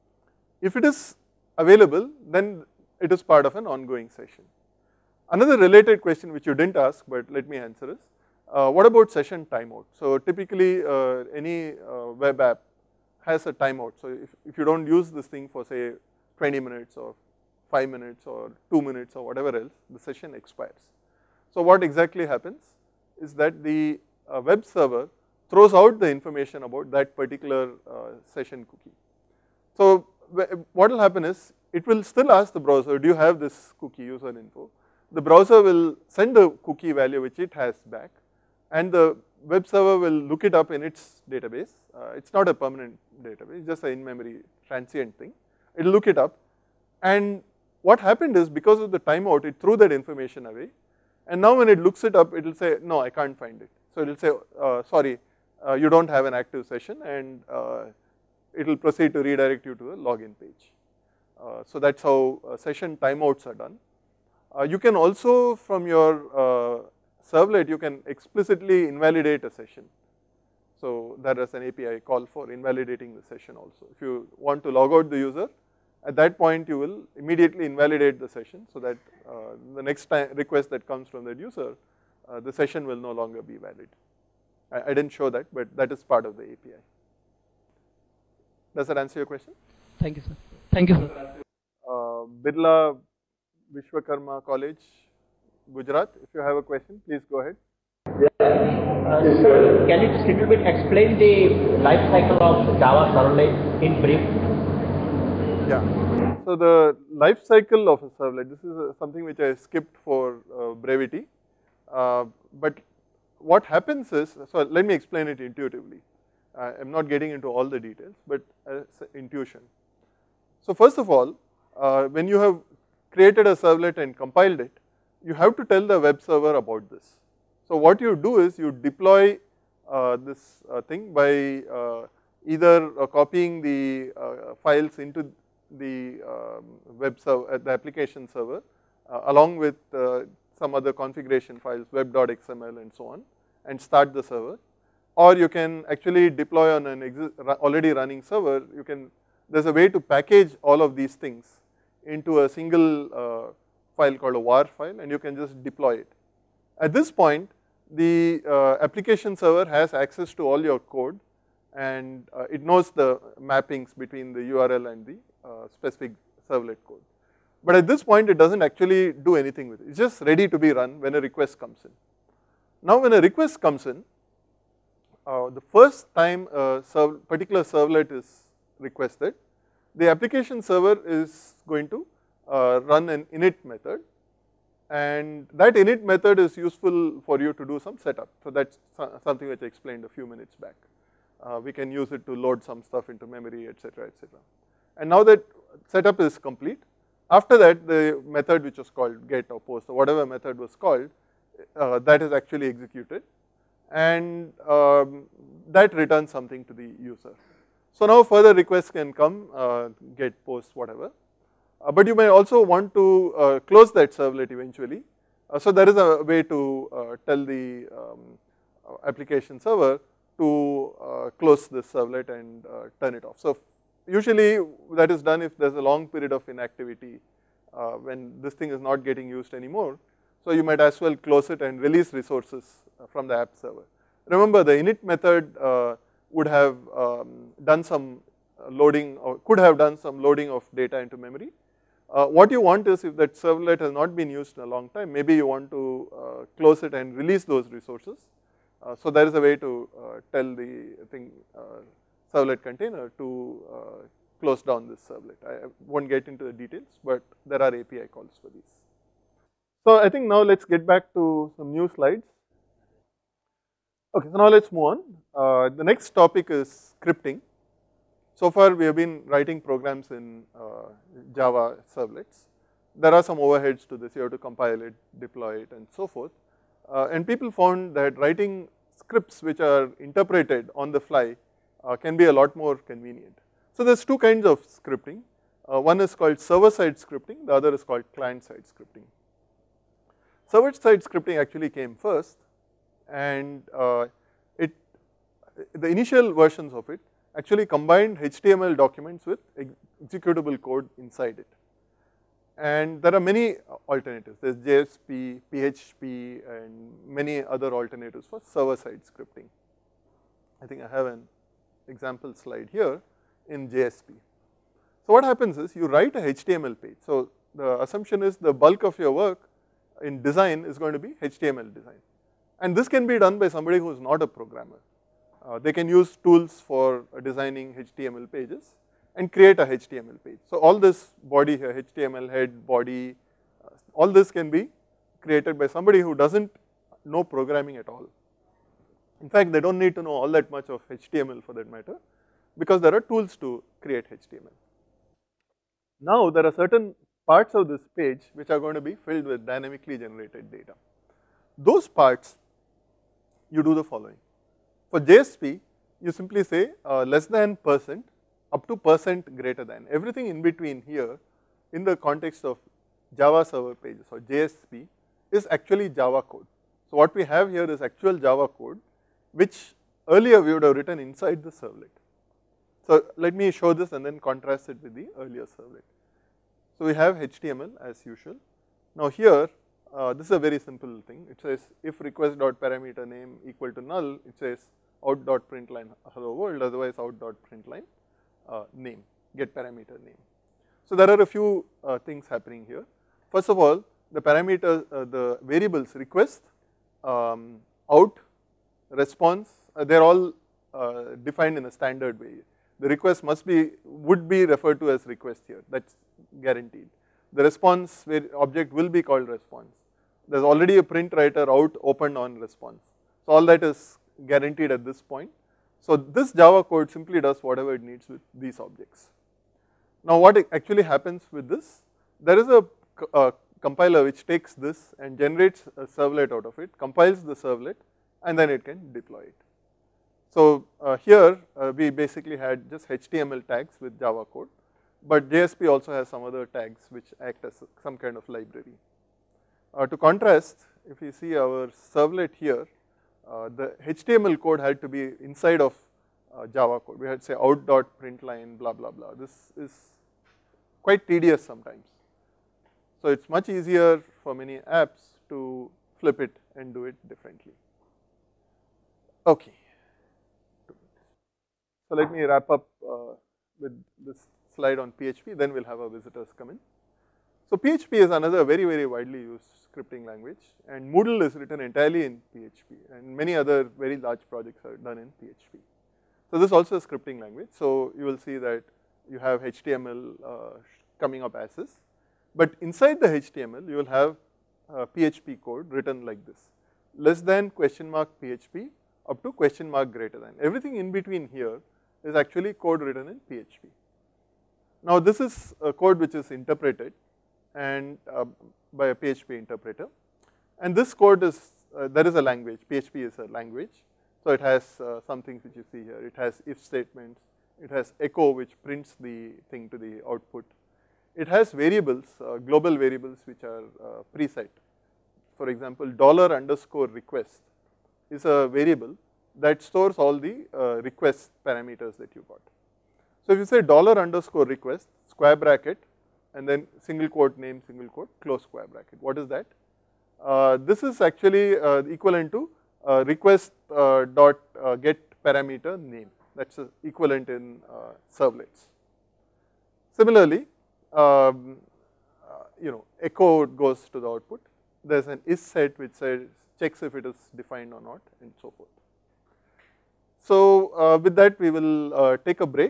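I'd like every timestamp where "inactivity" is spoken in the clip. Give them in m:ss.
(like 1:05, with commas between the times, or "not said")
3:46.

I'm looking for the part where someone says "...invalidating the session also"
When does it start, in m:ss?
1:12.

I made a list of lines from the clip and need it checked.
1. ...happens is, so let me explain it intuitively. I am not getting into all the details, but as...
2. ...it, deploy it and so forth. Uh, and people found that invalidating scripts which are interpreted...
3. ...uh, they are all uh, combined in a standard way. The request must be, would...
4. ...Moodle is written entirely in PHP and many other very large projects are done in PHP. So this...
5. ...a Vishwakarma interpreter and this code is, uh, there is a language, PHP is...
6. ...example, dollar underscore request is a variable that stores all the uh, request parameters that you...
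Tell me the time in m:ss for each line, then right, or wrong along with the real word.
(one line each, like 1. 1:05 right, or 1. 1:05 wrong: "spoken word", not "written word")
1. 1:53 right
2. 4:34 wrong: "writing", not "invalidating"
3. 6:39 wrong: "defined", not "combined"
4. 7:50 right
5. 8:18 wrong: "PHP", not "Vishwakarma"
6. 8:35 right.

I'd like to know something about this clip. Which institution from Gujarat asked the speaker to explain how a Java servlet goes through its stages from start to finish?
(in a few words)
Birla Vishwakarma College.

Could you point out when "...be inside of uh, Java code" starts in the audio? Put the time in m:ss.
7:24.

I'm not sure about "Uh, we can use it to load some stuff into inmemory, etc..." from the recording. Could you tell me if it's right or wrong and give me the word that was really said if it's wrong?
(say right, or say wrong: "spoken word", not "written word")
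wrong: "memory", not "inmemory".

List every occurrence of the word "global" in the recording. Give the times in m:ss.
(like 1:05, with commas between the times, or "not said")
8:32.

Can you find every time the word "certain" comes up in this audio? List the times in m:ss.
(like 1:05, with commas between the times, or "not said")
5:46.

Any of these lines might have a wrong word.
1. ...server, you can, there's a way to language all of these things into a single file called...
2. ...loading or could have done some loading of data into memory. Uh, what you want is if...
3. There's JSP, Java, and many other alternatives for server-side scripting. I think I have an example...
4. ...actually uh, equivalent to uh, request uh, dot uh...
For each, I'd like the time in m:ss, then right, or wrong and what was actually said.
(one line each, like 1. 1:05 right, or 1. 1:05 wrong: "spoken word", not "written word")
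1. 2:28 wrong: "package", not "language"
2. 3:58 right
3. 5:04 wrong: "PHP", not "Java"
4. 8:51 right.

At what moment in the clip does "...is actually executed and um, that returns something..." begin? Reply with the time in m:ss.
3:22.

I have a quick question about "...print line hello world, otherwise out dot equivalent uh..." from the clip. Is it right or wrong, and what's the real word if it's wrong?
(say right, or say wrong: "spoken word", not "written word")
wrong: "print", not "equivalent".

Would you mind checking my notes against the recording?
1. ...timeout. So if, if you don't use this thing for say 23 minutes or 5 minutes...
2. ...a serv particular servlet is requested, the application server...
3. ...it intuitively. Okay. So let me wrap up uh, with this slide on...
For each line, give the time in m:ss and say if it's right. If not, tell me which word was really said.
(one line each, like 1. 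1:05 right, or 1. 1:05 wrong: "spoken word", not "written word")
1. 0:13 wrong: "20", not "23"
2. 2:56 right
3. 7:36 wrong: "differently", not "intuitively".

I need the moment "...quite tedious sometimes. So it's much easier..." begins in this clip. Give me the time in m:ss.
7:30.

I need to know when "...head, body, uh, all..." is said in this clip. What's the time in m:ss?
5:32.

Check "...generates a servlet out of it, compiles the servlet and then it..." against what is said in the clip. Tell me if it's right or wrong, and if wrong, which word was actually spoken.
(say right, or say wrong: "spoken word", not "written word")
right.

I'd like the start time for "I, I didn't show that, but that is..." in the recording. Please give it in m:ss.
1:24.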